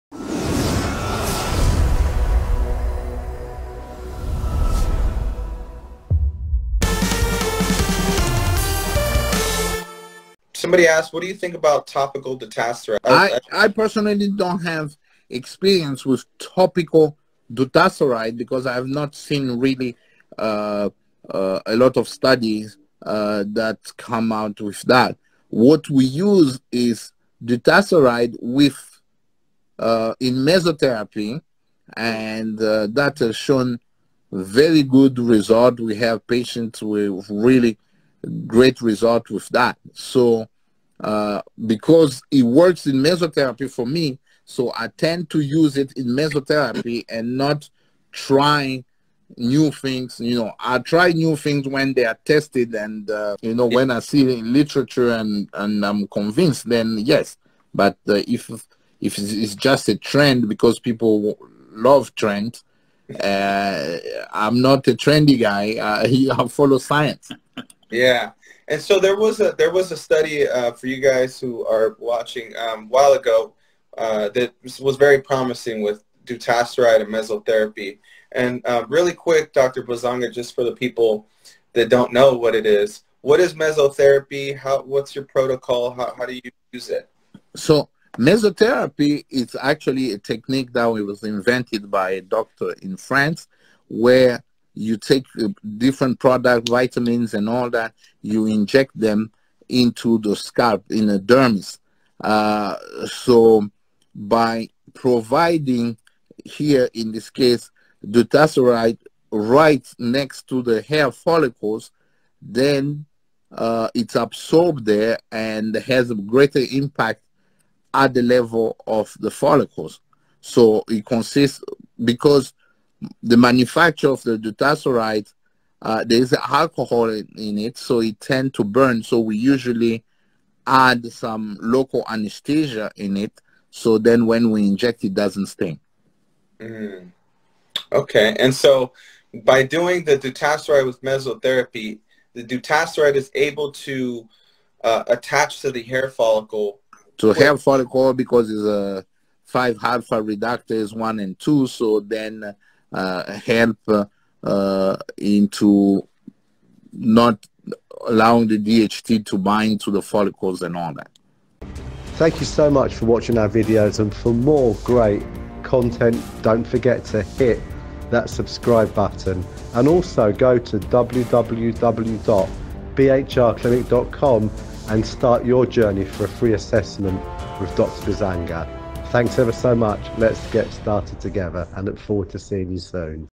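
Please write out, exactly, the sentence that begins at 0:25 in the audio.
What we use is dutasteride with uh, in mesotherapy, and uh, that has shown very good result.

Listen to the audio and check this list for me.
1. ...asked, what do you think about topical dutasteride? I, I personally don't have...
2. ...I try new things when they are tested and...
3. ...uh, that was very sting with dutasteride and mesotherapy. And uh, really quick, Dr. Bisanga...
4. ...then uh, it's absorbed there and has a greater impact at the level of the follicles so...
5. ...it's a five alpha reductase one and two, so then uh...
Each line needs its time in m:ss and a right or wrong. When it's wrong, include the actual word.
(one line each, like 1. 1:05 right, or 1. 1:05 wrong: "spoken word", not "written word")
1. 0:10 right
2. 0:50 right
3. 1:13 wrong: "promising", not "sting"
4. 1:52 right
5. 2:28 right.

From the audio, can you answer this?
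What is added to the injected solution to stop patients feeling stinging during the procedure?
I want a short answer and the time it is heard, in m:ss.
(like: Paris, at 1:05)
Local anesthesia, at 2:11.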